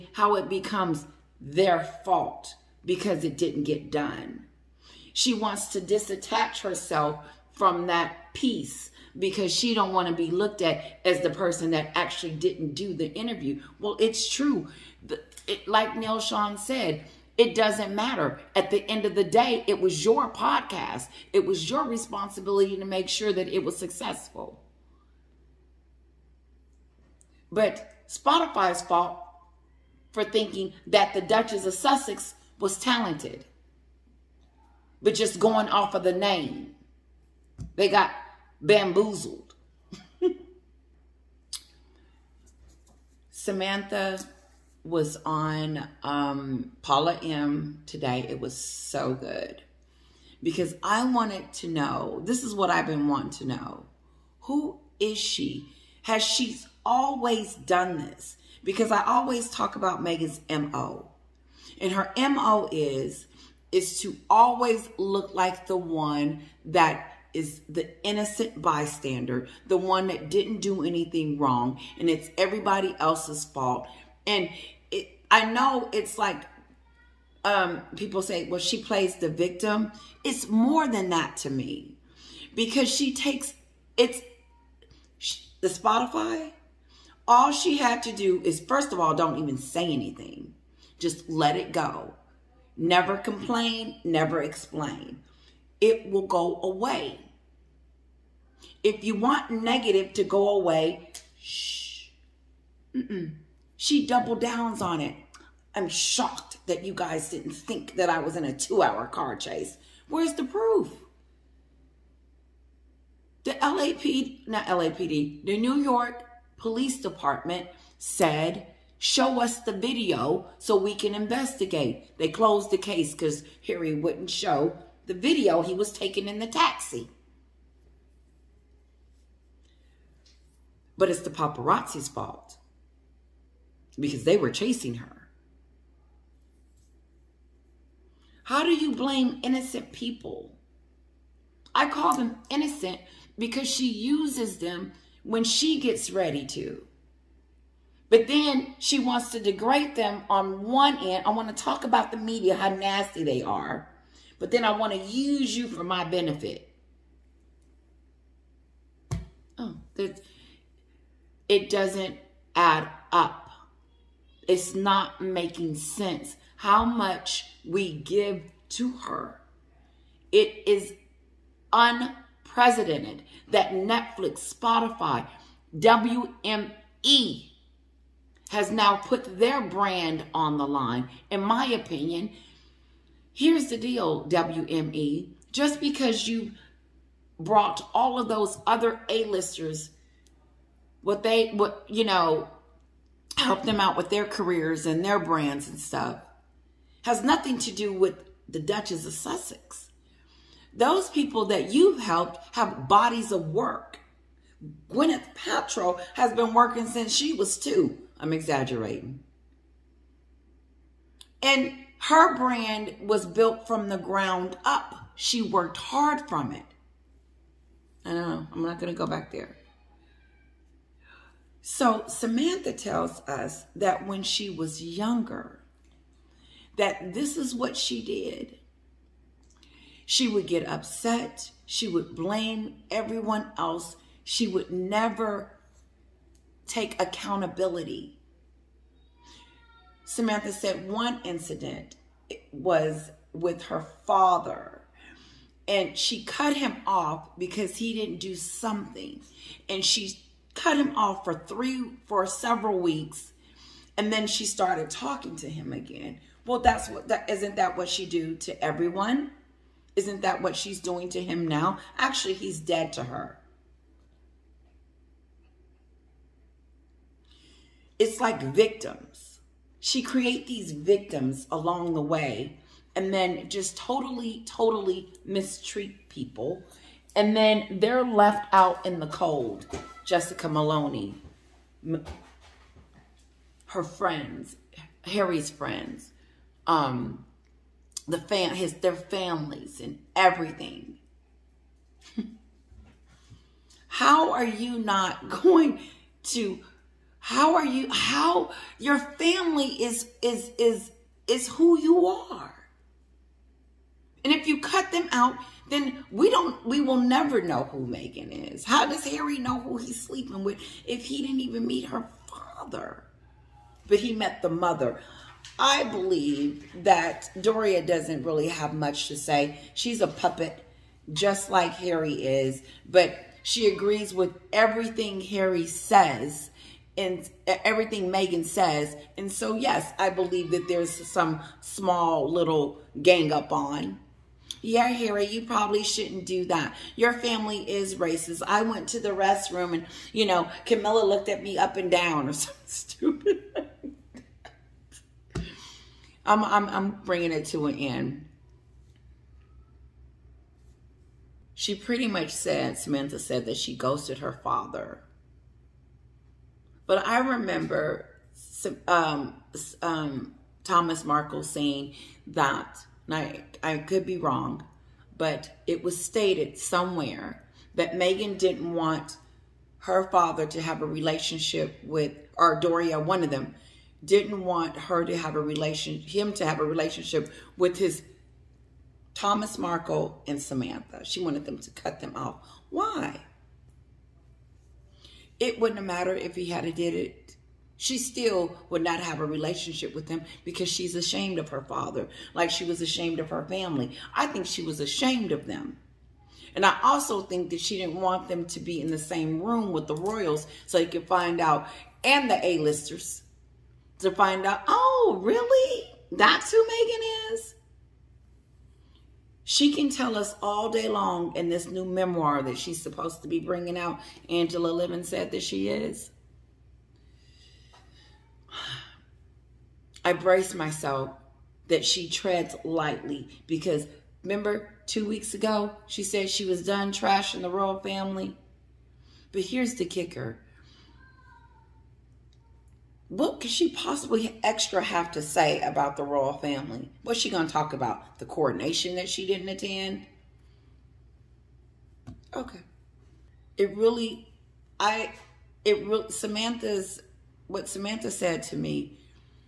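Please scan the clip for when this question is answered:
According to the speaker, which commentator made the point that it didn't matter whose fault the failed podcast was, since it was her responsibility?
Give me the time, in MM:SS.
00:15.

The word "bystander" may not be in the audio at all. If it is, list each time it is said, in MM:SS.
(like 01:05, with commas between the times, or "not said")
01:08.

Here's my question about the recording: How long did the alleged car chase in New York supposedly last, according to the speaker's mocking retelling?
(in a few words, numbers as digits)
2 hours.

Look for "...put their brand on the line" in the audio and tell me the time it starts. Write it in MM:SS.
02:58.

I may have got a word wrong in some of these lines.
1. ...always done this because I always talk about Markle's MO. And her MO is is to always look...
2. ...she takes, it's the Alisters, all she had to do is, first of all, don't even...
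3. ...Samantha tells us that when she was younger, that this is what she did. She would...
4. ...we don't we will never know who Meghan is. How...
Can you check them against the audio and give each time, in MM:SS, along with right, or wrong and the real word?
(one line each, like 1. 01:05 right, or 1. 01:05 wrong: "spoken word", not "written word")
1. 00:56 wrong: "Meghan", not "Markle"
2. 01:22 wrong: "Spotify", not "Alisters"
3. 03:42 right
4. 05:06 right.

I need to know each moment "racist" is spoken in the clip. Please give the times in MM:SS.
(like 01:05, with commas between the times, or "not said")
05:37.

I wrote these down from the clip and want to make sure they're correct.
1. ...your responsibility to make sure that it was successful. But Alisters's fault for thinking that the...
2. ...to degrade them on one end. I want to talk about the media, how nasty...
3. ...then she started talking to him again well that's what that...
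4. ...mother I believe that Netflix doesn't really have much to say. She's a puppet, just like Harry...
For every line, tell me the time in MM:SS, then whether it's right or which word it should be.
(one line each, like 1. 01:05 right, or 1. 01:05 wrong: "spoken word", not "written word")
1. 00:21 wrong: "Spotify", not "Alisters"
2. 02:29 right
3. 04:14 right
4. 05:14 wrong: "Doria", not "Netflix".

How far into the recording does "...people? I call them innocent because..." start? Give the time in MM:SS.
02:19.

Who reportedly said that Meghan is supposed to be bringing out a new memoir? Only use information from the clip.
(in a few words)
Angela Levin.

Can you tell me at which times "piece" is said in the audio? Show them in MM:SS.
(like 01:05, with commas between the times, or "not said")
00:08.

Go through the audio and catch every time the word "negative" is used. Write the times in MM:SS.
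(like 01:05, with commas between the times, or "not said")
01:39.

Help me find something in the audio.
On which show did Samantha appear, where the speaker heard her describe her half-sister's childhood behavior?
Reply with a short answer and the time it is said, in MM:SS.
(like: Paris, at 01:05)
Paula M, at 00:46.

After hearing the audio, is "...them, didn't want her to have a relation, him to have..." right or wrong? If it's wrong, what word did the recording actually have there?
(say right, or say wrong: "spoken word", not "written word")
right.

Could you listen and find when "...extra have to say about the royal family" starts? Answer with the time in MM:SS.
07:14.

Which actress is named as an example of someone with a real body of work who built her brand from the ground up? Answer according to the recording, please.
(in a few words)
Gwyneth Paltrow.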